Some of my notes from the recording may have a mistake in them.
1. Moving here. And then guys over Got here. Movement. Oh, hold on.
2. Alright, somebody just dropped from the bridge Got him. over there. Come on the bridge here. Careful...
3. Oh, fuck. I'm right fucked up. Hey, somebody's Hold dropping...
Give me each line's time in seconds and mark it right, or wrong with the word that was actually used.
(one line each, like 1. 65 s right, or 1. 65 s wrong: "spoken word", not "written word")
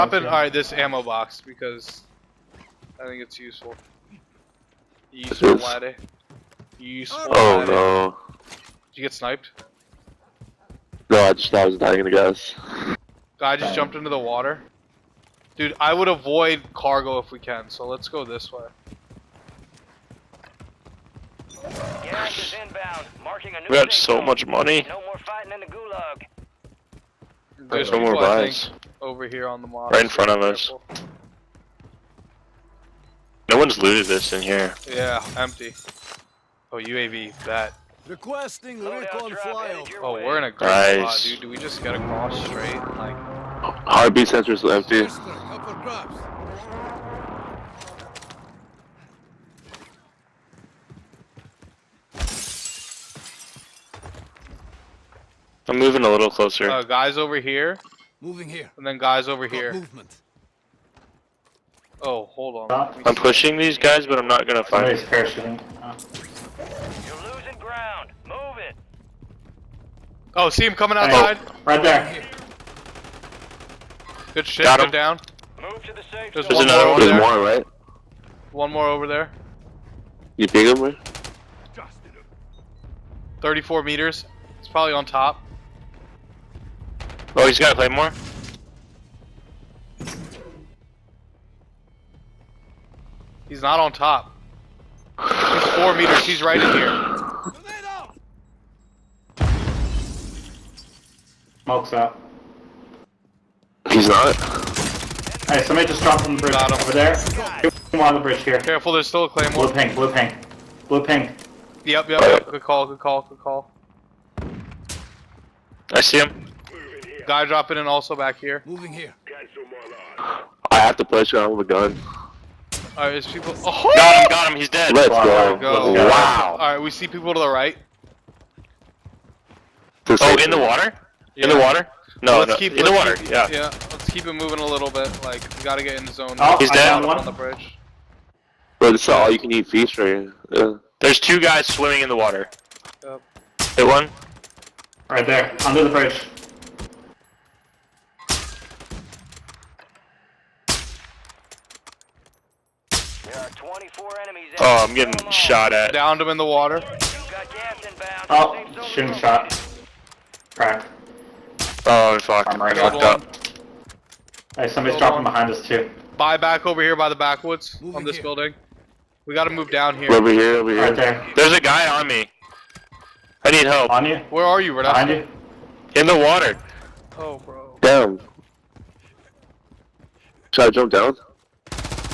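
1. 58 s right
2. 105 s right
3. 161 s right.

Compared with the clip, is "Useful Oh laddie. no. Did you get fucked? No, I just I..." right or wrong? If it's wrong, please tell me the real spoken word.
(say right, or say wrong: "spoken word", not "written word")
wrong: "sniped", not "fucked".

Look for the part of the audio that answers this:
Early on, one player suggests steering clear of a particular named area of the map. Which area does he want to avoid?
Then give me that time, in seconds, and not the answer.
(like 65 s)
16 s.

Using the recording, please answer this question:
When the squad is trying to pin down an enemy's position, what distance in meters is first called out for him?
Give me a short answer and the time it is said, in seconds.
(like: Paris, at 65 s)
34 meters, at 83 s.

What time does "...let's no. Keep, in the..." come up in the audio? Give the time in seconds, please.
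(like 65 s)
132 s.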